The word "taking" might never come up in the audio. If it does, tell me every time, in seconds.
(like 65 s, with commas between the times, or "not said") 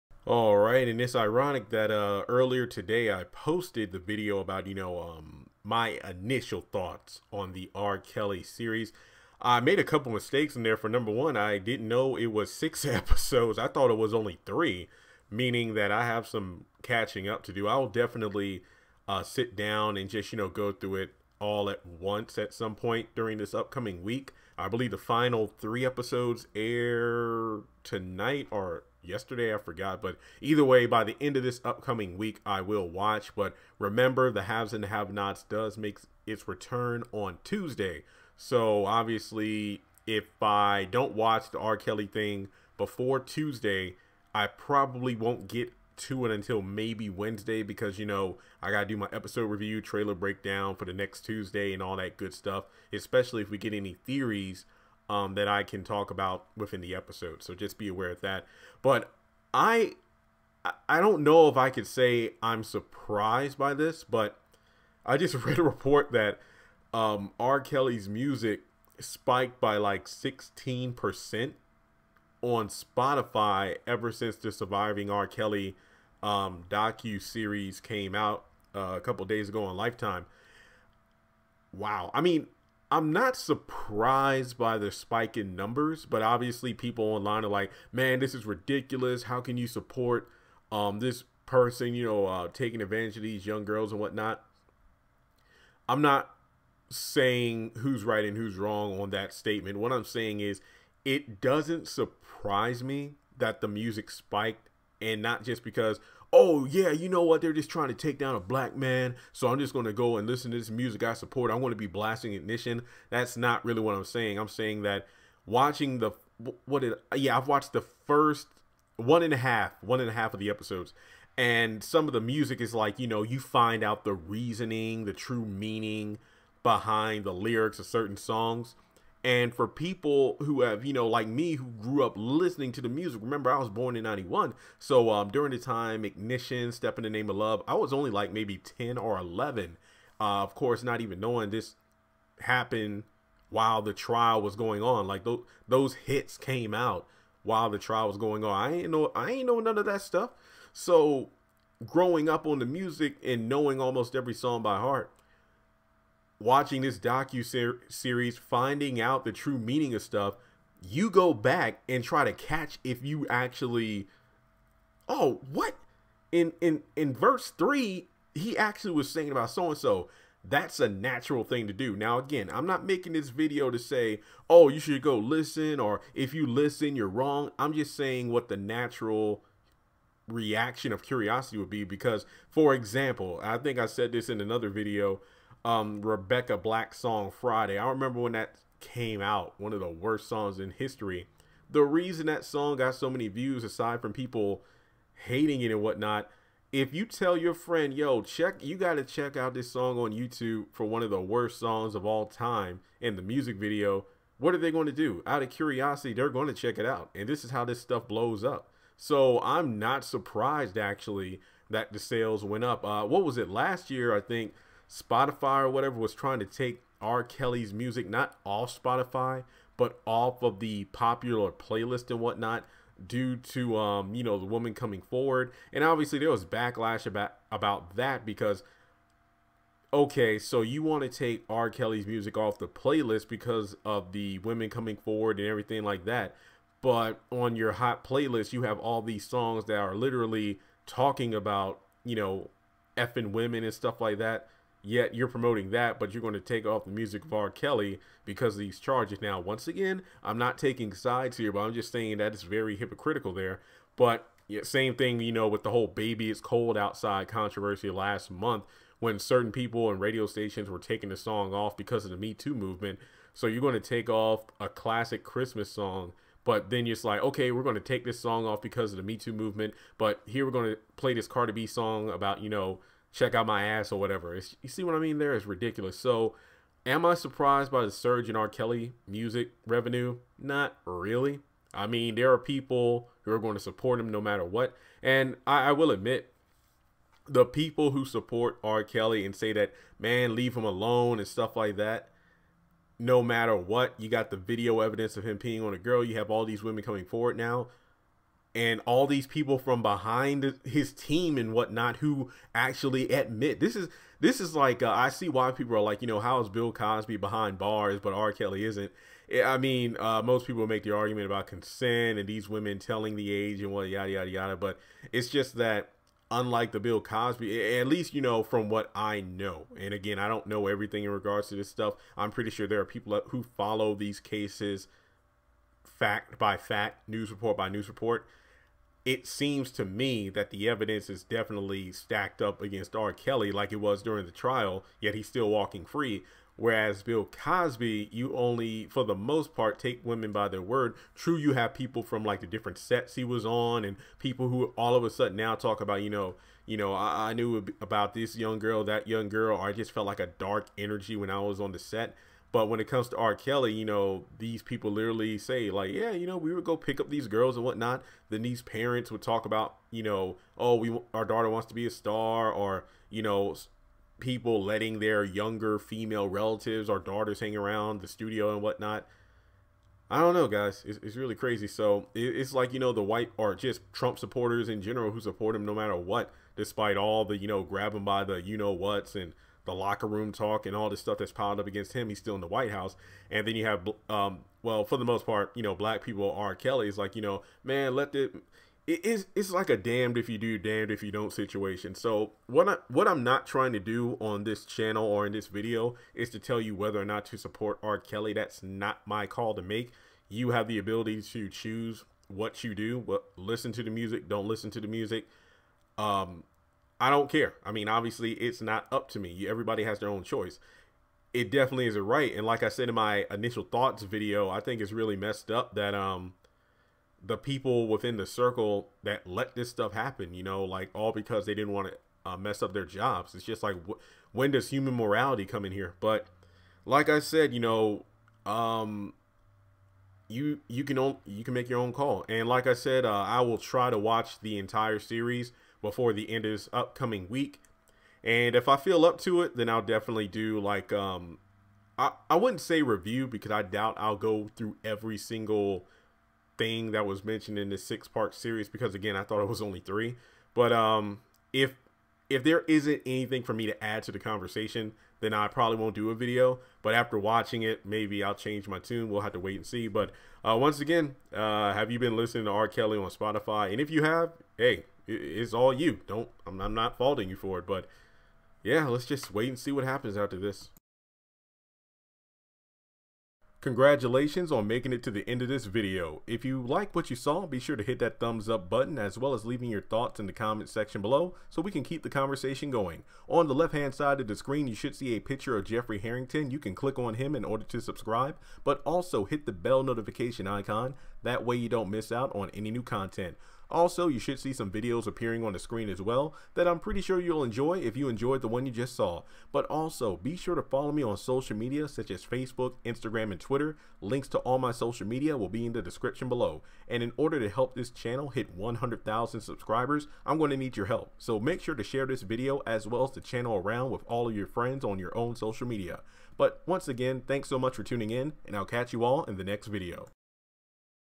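92 s, 250 s, 260 s.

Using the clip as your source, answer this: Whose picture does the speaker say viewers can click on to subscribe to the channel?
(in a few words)
Jeffrey Harrington.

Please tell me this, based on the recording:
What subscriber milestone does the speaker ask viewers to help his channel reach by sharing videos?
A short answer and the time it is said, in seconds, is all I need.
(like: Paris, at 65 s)
100,000, at 508 s.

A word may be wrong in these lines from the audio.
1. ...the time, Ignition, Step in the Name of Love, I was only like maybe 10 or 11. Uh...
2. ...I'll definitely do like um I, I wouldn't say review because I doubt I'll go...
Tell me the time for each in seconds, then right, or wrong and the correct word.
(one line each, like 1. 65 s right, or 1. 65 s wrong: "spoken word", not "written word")
1. 135 s right
2. 439 s right.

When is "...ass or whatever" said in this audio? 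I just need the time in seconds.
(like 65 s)
273 s.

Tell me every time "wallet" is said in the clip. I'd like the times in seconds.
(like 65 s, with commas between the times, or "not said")
not said.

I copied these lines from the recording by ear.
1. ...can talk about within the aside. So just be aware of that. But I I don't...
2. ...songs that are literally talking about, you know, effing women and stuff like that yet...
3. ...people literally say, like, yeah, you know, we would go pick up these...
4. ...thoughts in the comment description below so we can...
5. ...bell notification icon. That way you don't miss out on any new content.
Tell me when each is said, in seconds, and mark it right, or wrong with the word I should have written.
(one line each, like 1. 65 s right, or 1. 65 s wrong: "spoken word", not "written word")
1. 55 s wrong: "episode", not "aside"
2. 239 s right
3. 354 s right
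4. 479 s wrong: "section", not "description"
5. 489 s right.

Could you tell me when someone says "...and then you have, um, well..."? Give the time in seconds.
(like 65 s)
383 s.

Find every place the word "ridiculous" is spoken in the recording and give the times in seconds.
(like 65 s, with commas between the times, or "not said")
88 s, 275 s.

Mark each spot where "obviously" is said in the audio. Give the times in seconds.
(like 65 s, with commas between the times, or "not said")
38 s, 86 s, 225 s, 407 s.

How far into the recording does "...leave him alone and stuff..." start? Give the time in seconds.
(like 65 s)
290 s.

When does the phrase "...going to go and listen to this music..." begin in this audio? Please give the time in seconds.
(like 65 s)
109 s.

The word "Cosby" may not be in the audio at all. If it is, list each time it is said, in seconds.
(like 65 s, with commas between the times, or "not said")
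306 s, 316 s, 337 s.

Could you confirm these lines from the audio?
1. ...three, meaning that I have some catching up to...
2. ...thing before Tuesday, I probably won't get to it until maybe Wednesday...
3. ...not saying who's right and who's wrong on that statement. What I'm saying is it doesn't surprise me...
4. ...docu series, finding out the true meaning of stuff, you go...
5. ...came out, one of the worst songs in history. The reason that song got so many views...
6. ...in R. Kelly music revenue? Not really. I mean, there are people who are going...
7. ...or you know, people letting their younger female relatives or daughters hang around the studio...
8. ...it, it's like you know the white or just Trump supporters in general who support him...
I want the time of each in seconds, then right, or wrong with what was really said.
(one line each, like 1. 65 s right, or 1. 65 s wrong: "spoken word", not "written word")
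1. 14 s right
2. 42 s right
3. 96 s right
4. 156 s right
5. 188 s right
6. 278 s right
7. 362 s right
8. 372 s right.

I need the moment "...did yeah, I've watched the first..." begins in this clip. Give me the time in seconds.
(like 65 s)
116 s.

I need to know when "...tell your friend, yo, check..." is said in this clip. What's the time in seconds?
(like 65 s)
197 s.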